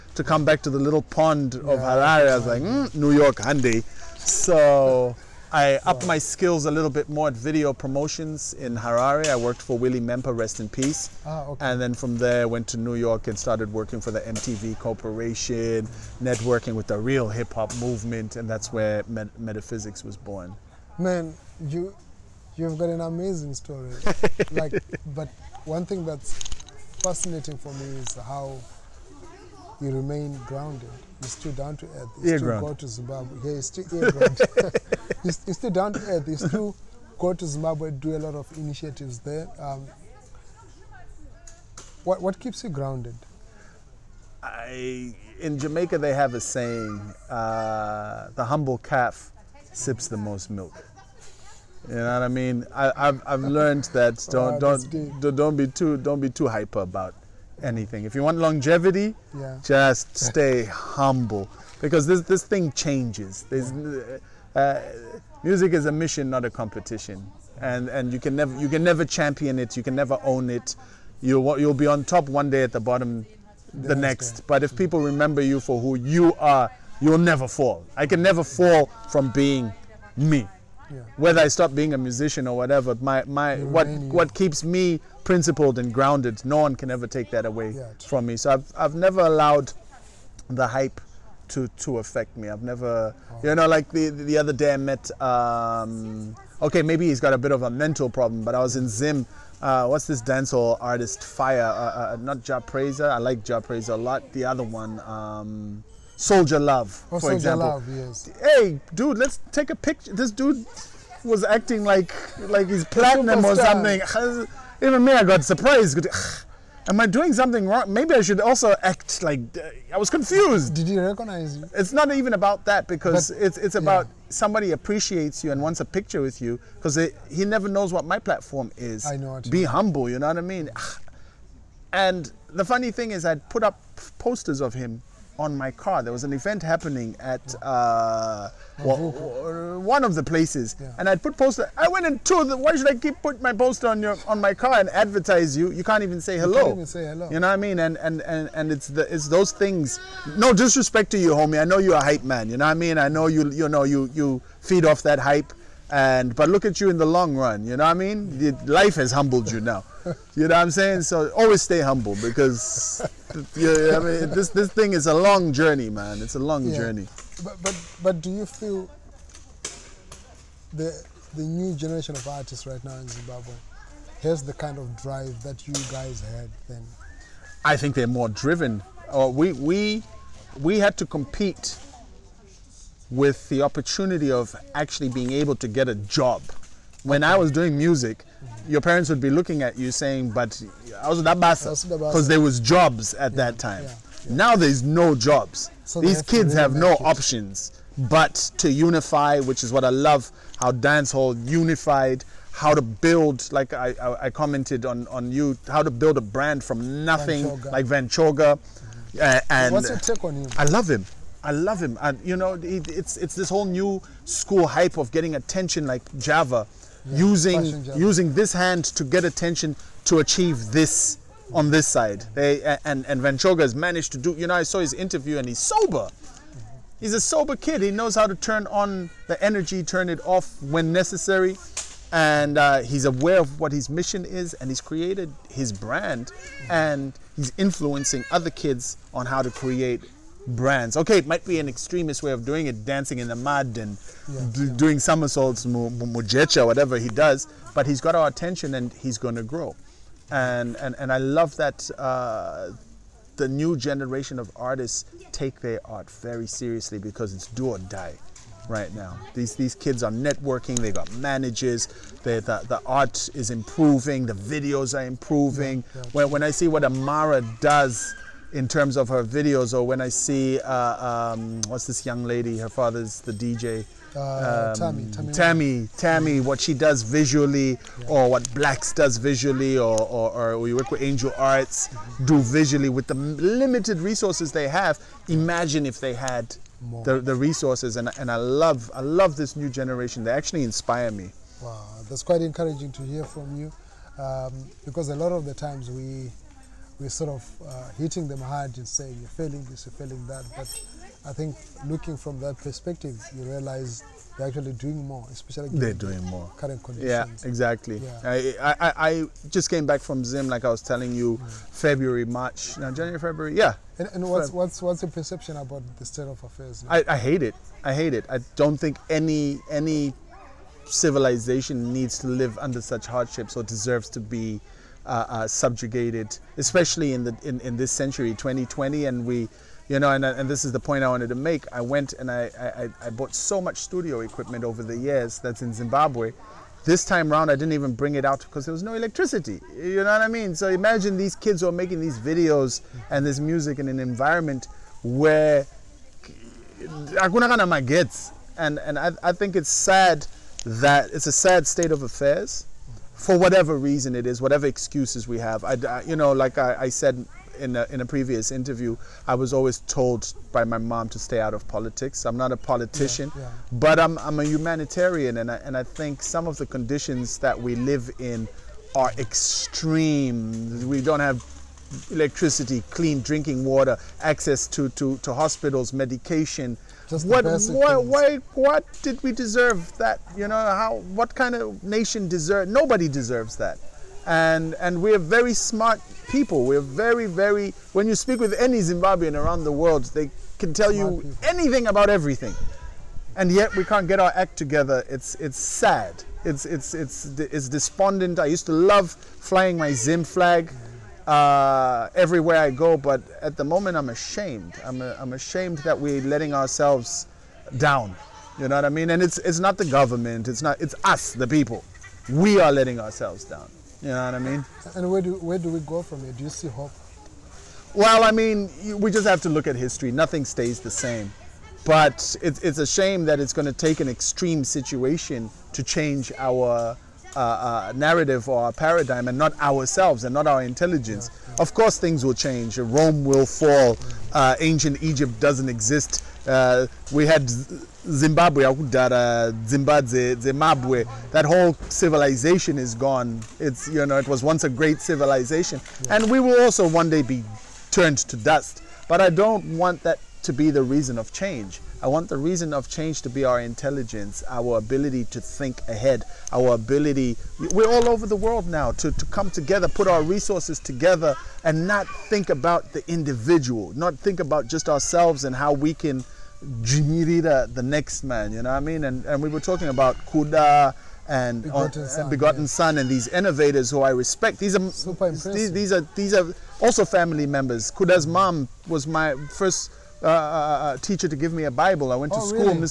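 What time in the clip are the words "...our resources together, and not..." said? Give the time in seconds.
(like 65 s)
460 s.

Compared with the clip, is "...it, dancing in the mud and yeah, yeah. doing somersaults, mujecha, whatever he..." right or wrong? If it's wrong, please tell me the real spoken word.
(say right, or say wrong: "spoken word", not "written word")
right.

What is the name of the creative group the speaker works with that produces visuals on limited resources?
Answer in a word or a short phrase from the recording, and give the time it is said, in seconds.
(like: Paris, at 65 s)
Angel Arts, at 281 s.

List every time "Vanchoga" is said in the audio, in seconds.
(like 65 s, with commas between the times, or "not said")
207 s, 223 s.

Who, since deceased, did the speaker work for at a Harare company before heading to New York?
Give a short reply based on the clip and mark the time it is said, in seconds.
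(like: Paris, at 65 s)
Willie Mempa, at 9 s.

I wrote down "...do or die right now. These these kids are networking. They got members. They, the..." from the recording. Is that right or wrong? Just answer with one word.
wrong.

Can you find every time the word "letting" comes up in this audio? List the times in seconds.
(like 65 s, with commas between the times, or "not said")
406 s, 412 s.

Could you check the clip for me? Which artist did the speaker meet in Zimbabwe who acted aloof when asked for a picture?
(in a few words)
Soul Jah Love.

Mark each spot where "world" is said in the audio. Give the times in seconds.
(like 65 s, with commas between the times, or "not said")
389 s, 458 s.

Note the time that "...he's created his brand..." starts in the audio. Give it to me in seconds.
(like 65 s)
234 s.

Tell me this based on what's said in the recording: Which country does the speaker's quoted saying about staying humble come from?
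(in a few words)
Jamaica.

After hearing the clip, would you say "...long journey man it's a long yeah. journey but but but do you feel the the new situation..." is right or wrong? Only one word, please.
wrong.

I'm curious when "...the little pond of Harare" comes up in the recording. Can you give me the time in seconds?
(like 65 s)
0 s.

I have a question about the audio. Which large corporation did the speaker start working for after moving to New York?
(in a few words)
MTV.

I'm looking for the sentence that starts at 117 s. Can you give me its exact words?
Maybe I should also act like uh, I was confused.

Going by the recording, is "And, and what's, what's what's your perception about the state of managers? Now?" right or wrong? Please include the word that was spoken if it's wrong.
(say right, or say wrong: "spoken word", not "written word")
wrong: "affairs", not "managers".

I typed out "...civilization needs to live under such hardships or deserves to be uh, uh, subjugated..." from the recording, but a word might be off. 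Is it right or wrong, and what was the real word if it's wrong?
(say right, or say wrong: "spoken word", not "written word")
right.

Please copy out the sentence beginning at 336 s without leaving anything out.
This time round, I didn't even bring it out because there was no electricity.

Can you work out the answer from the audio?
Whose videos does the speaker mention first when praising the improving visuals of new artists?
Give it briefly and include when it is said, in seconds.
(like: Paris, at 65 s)
Amara, at 266 s.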